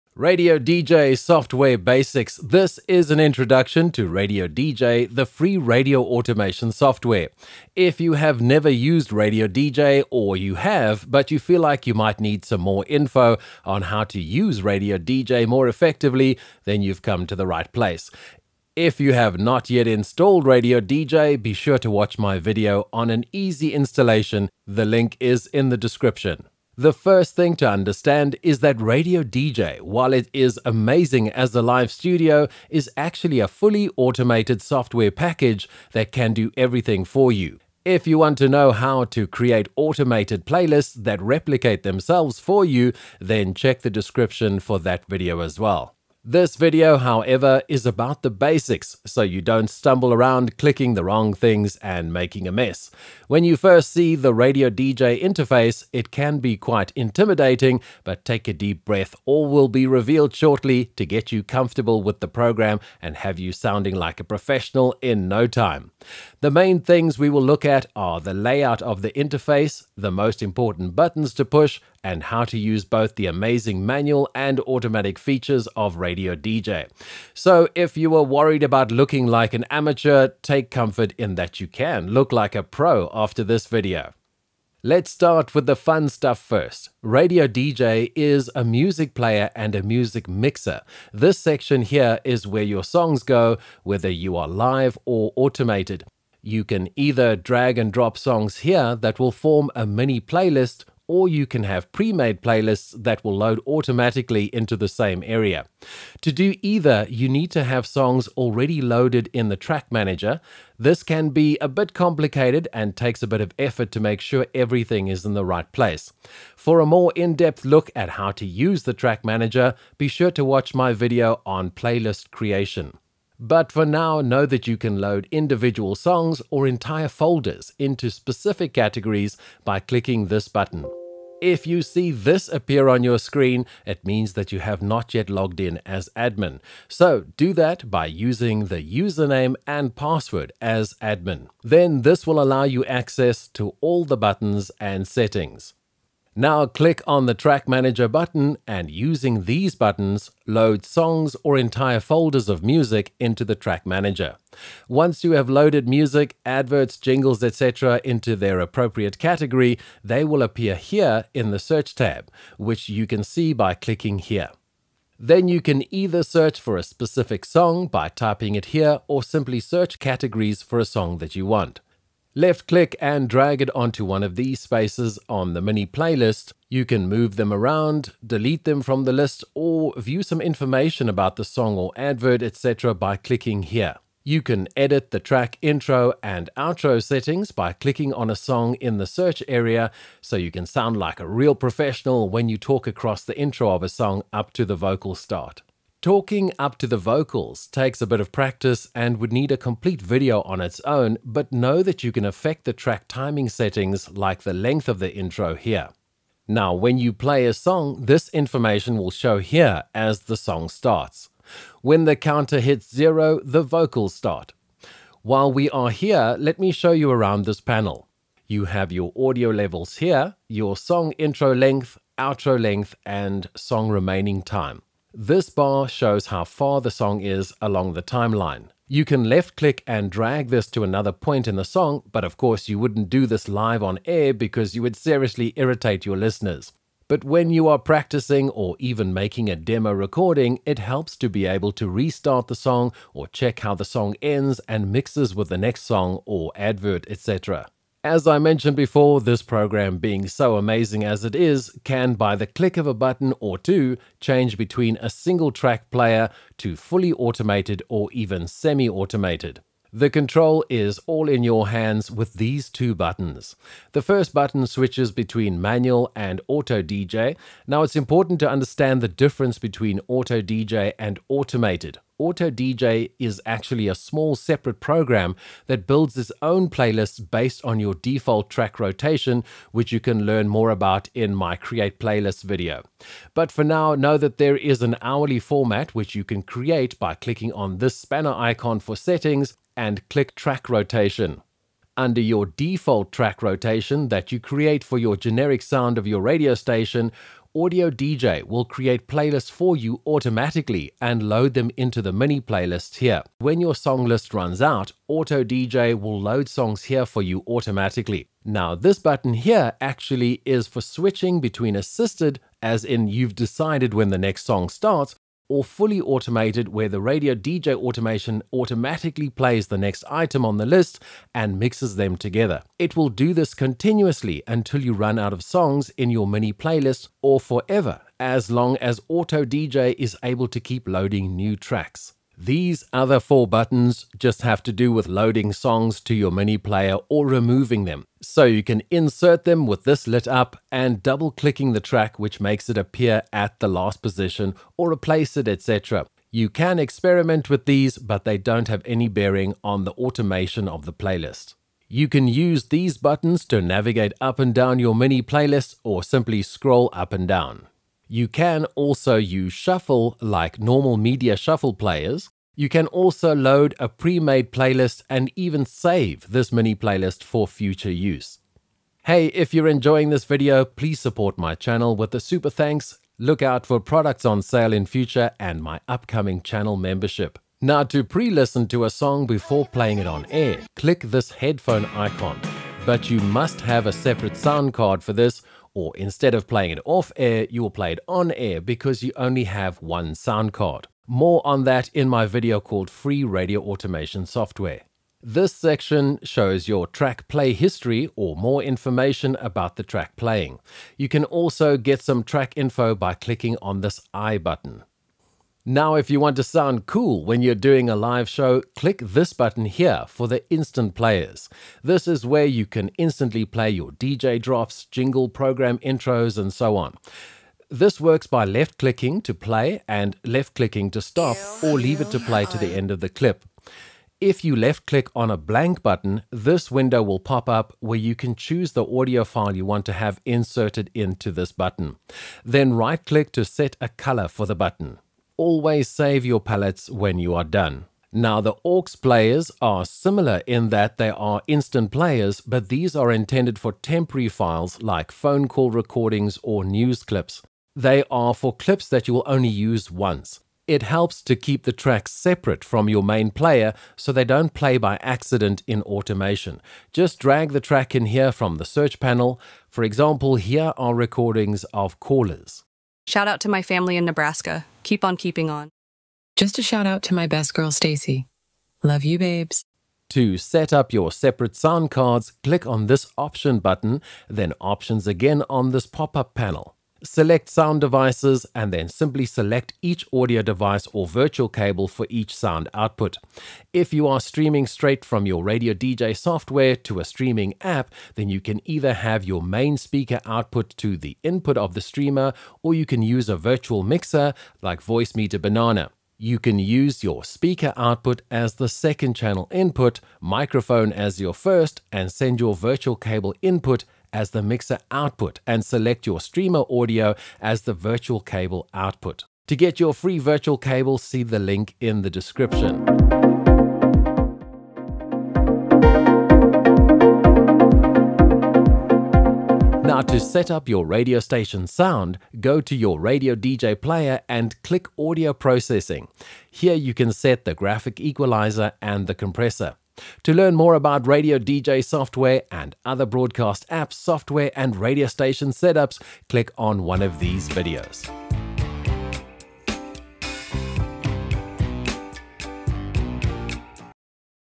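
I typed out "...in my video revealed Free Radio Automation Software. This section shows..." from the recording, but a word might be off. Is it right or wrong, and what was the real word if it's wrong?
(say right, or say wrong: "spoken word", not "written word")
wrong: "called", not "revealed".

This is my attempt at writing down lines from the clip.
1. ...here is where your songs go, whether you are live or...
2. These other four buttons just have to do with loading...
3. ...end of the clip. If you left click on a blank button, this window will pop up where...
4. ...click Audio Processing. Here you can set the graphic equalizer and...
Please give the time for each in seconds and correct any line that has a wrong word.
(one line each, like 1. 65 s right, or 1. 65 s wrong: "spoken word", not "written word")
1. 91 s right
2. 332 s right
3. 422 s right
4. 524 s right.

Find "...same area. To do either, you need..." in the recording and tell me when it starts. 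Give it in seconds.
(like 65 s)
104 s.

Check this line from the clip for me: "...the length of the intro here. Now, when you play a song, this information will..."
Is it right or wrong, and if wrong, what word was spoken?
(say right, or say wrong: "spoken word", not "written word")
right.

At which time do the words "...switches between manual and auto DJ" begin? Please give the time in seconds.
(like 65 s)
264 s.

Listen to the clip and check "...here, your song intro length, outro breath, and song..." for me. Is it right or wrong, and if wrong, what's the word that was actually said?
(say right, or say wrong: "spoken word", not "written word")
wrong: "length", not "breath".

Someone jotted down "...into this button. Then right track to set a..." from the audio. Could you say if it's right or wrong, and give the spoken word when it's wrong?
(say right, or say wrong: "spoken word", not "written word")
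wrong: "click", not "track".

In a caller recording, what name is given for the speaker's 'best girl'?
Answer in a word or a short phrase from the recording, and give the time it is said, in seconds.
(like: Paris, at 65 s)
Stacy, at 467 s.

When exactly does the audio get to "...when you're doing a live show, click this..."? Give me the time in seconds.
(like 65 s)
407 s.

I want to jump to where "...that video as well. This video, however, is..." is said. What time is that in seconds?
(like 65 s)
44 s.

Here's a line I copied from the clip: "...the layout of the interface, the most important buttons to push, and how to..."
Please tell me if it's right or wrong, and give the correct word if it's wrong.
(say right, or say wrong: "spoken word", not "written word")
right.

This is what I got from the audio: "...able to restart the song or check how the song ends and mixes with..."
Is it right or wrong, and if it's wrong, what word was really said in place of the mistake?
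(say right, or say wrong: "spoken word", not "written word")
right.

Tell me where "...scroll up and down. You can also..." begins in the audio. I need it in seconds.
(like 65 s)
356 s.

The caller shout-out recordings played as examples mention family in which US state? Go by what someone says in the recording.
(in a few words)
Nebraska.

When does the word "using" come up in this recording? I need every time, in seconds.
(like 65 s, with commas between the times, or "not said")
138 s, 148 s.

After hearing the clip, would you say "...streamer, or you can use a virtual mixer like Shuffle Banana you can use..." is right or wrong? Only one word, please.
wrong.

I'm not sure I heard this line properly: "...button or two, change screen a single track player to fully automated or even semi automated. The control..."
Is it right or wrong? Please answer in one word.
wrong.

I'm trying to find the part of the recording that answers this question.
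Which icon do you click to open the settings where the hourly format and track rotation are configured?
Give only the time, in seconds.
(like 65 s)
287 s.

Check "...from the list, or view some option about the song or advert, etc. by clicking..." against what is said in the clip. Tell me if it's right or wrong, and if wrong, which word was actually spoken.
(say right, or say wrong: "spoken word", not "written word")
wrong: "information", not "option".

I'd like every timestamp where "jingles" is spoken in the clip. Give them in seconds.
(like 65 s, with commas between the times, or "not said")
156 s, 414 s.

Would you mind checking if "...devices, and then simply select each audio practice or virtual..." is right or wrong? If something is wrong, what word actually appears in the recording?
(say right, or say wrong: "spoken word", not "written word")
wrong: "device", not "practice".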